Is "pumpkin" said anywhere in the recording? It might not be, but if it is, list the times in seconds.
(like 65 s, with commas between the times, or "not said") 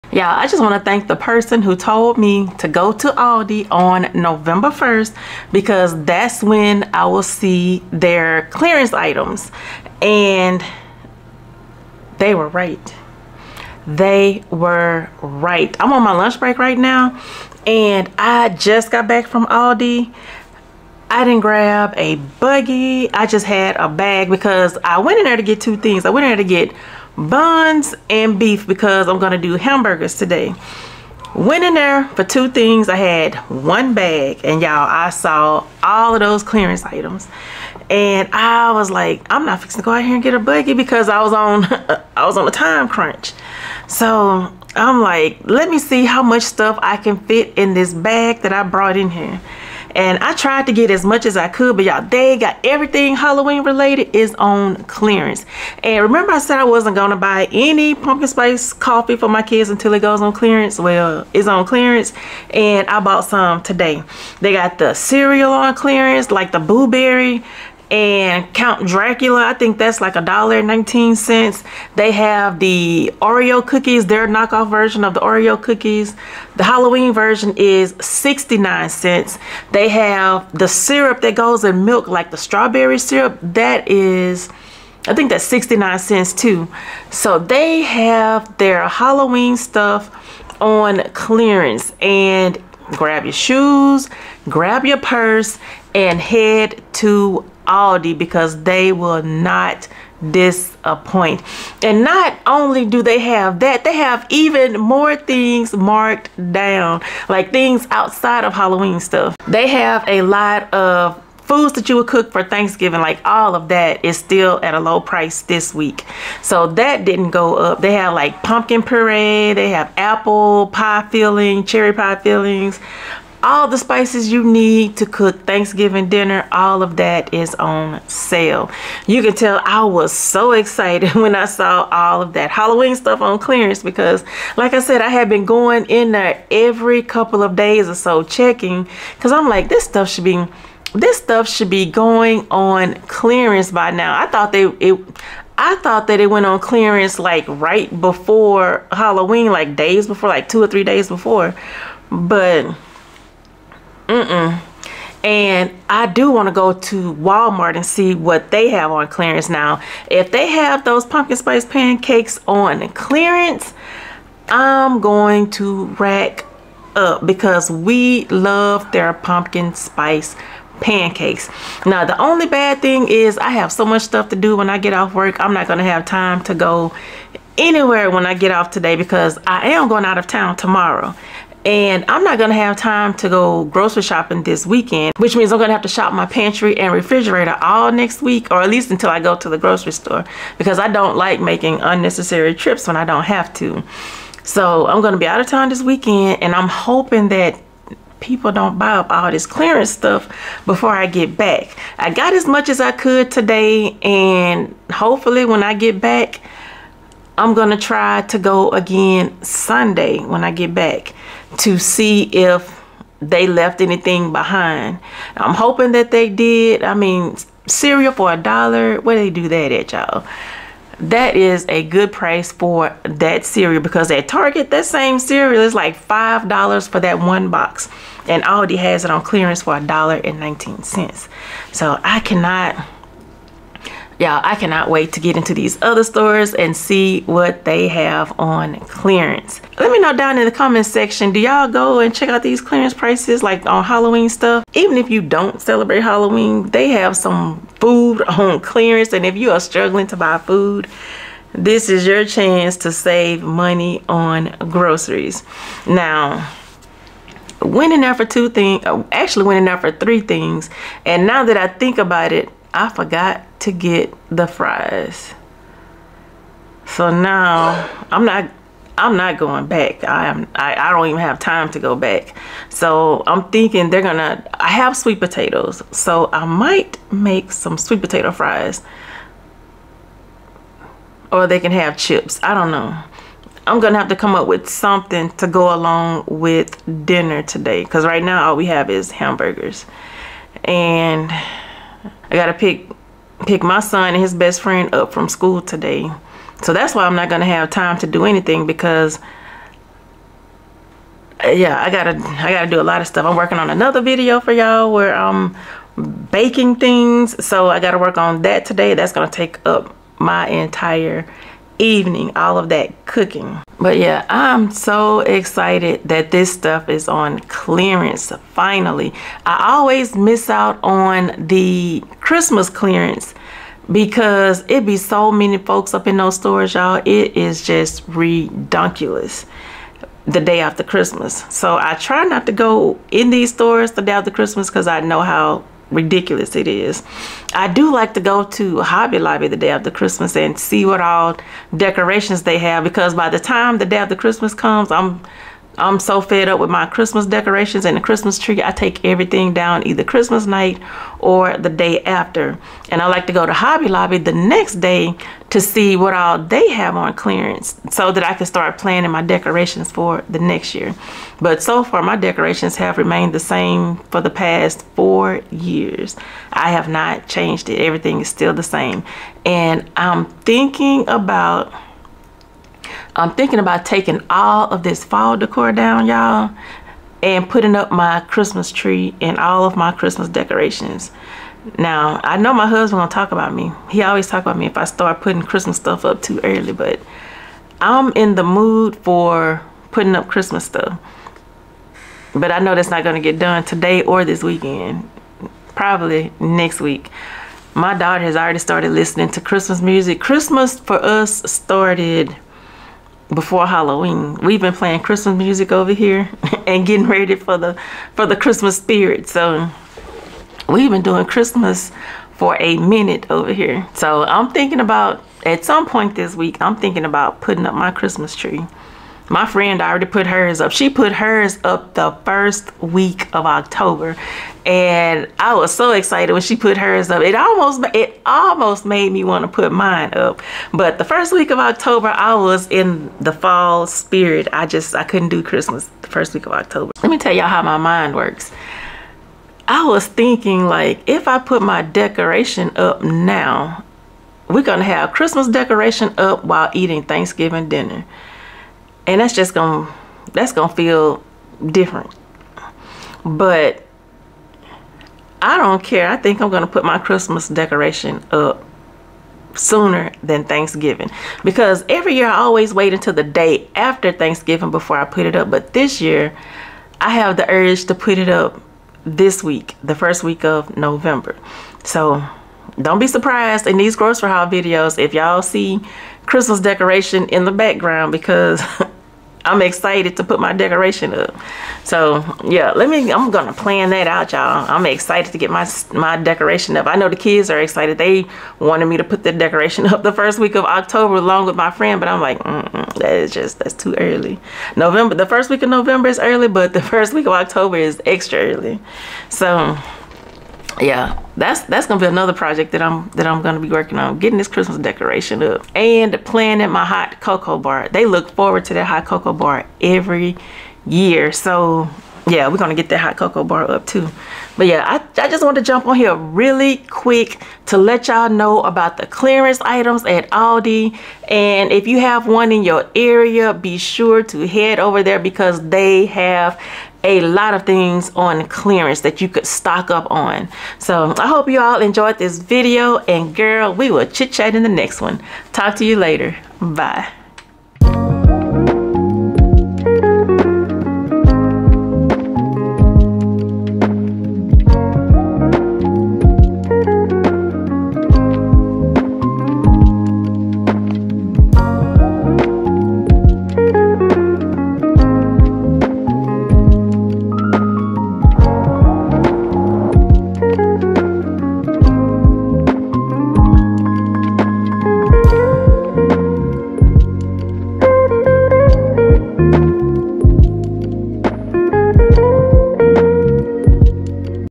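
57 s, 118 s, 161 s, 169 s.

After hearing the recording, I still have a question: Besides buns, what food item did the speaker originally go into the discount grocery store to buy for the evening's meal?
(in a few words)
beef.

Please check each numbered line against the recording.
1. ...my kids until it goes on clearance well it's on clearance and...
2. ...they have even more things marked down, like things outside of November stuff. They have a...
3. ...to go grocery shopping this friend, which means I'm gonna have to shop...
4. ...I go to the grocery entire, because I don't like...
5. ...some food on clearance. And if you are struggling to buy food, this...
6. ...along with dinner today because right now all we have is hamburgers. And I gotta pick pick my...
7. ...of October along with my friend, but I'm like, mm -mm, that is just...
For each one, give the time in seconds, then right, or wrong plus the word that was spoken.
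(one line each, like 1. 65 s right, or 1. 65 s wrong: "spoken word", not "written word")
1. 59 s right
2. 103 s wrong: "Halloween", not "November"
3. 183 s wrong: "weekend", not "friend"
4. 189 s wrong: "store", not "entire"
5. 247 s right
6. 285 s right
7. 490 s right.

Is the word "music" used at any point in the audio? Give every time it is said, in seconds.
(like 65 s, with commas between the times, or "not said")
399 s, 405 s.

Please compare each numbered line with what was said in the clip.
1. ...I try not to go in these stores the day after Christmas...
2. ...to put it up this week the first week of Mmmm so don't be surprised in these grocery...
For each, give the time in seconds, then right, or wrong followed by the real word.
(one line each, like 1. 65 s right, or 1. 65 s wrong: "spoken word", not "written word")
1. 331 s right
2. 467 s wrong: "November", not "Mmmm".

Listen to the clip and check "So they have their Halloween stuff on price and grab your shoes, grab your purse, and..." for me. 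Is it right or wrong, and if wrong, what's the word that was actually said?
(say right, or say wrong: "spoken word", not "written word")
wrong: "clearance", not "price".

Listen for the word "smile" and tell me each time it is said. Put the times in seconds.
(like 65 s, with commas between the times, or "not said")
not said.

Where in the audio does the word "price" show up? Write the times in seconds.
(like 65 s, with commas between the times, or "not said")
115 s, 222 s, 242 s.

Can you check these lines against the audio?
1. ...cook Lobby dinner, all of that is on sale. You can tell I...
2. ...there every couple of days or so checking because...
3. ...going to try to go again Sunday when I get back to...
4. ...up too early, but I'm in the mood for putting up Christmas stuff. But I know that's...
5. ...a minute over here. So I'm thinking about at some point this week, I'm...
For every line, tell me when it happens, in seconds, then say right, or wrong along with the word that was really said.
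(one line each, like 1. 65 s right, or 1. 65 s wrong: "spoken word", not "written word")
1. 125 s wrong: "Thanksgiving", not "Lobby"
2. 136 s right
3. 207 s right
4. 386 s right
5. 412 s right.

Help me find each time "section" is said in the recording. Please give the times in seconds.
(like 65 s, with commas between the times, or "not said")
240 s.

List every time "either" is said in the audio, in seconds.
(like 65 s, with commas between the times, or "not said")
349 s.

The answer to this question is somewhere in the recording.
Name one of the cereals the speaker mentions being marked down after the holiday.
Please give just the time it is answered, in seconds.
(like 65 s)
68 s.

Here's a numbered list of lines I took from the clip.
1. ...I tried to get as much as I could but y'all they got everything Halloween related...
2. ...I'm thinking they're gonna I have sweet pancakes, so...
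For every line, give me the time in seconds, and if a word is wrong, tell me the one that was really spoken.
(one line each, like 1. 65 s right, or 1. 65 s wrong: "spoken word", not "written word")
1. 50 s right
2. 273 s wrong: "potatoes", not "pancakes".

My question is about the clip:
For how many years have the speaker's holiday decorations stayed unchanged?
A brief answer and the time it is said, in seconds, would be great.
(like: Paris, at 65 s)
4 years, at 364 s.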